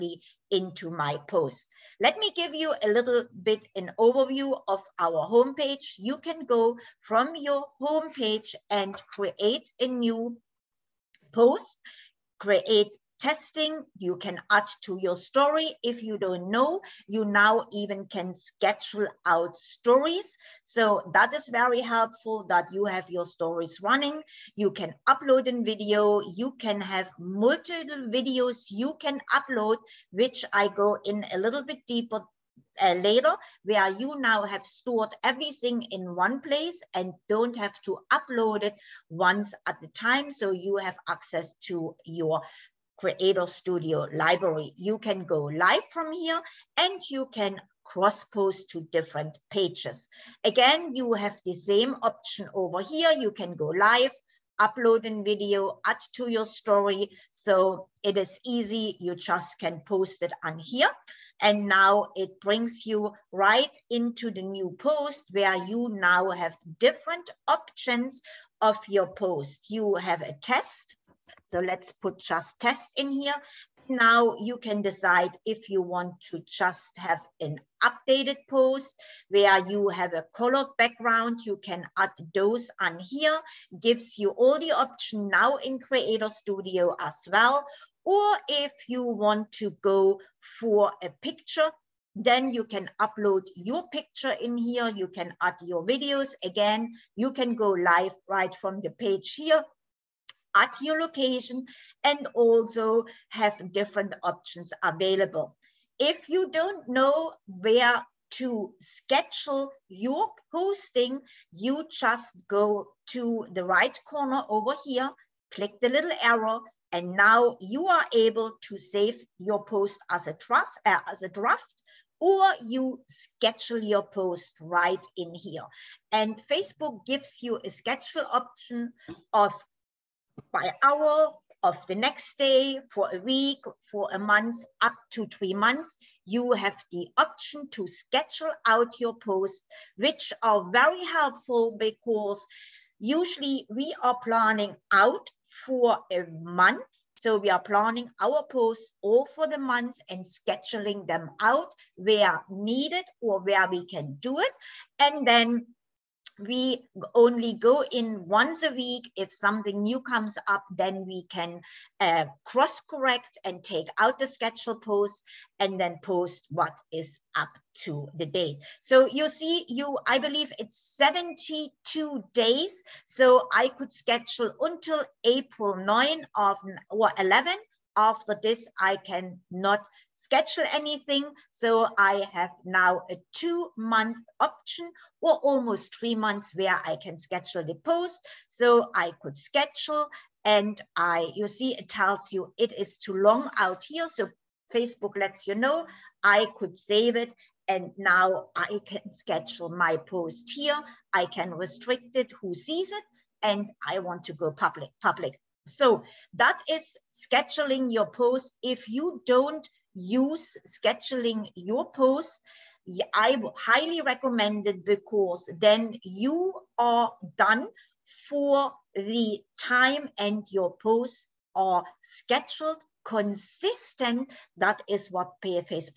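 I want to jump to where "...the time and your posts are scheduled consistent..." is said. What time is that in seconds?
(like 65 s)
218 s.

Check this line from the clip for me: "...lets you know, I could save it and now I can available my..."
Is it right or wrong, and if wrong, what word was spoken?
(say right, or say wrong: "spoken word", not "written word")
wrong: "schedule", not "available".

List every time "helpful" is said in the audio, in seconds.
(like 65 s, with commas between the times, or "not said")
21 s, 141 s.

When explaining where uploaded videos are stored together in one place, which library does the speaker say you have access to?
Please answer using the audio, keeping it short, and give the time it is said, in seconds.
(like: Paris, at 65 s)
Creator Studio library, at 43 s.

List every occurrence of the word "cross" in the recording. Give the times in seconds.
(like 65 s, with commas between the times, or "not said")
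47 s, 162 s.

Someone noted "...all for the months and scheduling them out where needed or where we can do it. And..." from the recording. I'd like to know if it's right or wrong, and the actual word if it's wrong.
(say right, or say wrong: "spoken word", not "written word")
right.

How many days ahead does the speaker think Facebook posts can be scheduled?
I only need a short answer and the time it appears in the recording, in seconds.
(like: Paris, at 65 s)
72, at 170 s.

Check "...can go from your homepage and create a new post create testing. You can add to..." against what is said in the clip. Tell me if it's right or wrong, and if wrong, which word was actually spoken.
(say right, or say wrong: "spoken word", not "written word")
right.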